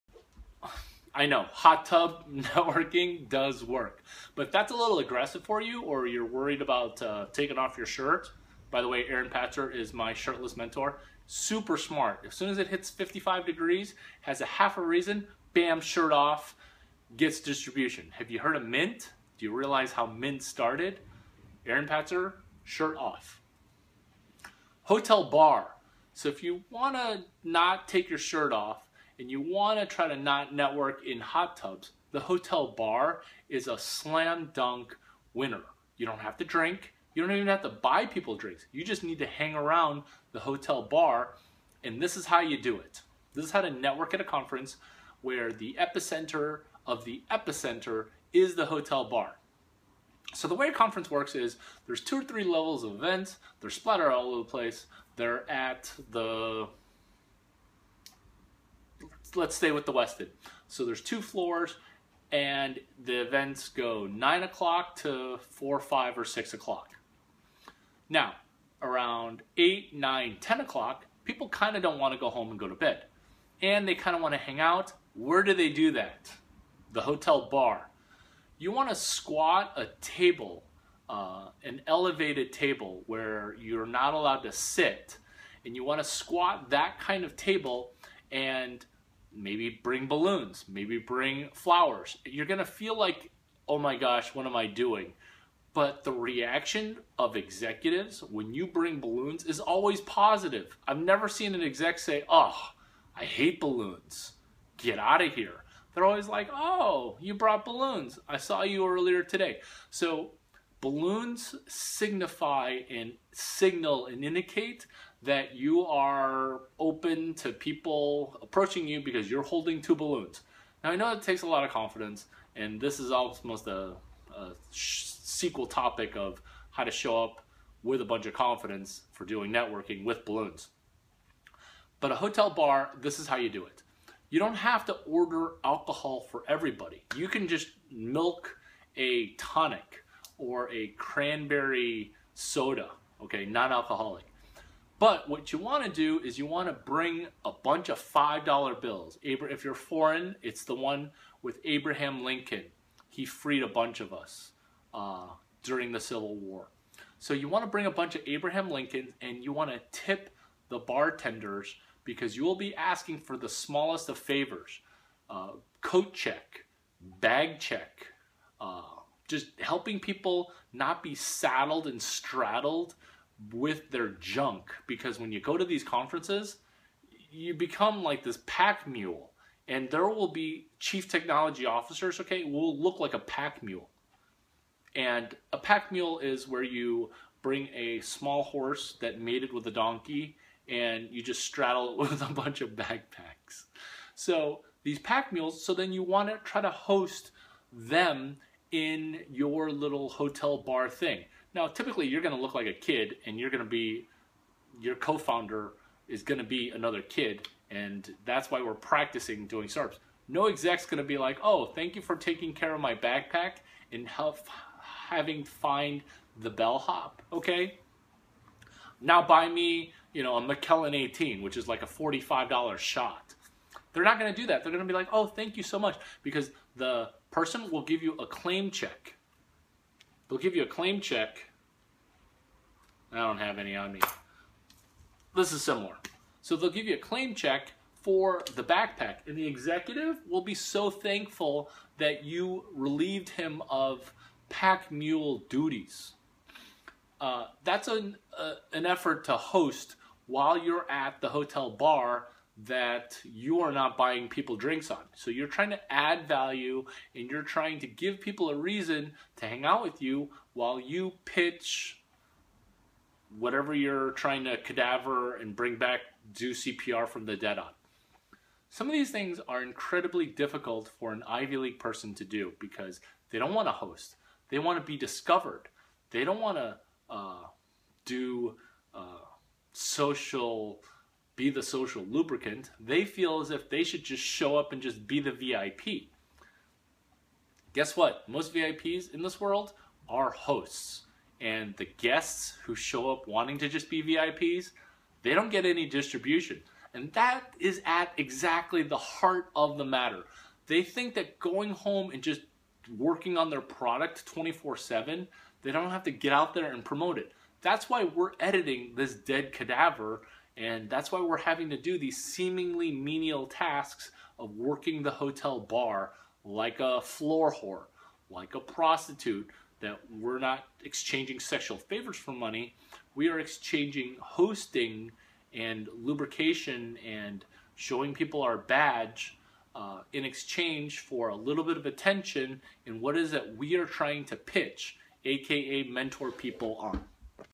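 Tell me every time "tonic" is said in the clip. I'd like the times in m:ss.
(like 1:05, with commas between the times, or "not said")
2:19.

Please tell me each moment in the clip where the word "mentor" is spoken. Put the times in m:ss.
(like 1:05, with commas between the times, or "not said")
0:10, 5:35.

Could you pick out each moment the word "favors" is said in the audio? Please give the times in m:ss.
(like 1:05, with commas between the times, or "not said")
2:44, 5:21.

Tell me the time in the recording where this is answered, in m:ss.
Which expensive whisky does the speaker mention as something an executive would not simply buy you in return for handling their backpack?
3:40.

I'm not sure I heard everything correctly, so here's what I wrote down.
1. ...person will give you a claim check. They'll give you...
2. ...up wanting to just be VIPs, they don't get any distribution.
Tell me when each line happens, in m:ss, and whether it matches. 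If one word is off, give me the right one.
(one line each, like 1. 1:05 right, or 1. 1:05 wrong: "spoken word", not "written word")
1. 3:47 right
2. 4:53 right.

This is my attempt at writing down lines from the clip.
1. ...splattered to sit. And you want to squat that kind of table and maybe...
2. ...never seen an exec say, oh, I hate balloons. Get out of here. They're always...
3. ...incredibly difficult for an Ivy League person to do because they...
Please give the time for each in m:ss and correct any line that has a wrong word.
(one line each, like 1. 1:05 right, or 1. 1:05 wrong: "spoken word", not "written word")
1. 1:24 wrong: "allowed", not "splattered"
2. 1:40 right
3. 4:29 right.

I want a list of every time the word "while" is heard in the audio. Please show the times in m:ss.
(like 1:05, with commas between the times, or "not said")
4:10, 4:20.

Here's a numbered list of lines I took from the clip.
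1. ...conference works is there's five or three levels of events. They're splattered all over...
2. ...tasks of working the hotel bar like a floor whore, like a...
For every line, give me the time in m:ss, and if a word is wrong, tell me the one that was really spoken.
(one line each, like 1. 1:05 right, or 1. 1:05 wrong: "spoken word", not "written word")
1. 0:50 wrong: "two", not "five"
2. 5:13 right.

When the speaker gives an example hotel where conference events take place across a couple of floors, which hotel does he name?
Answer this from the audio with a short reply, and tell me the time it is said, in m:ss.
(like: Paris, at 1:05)
Westin, at 0:59.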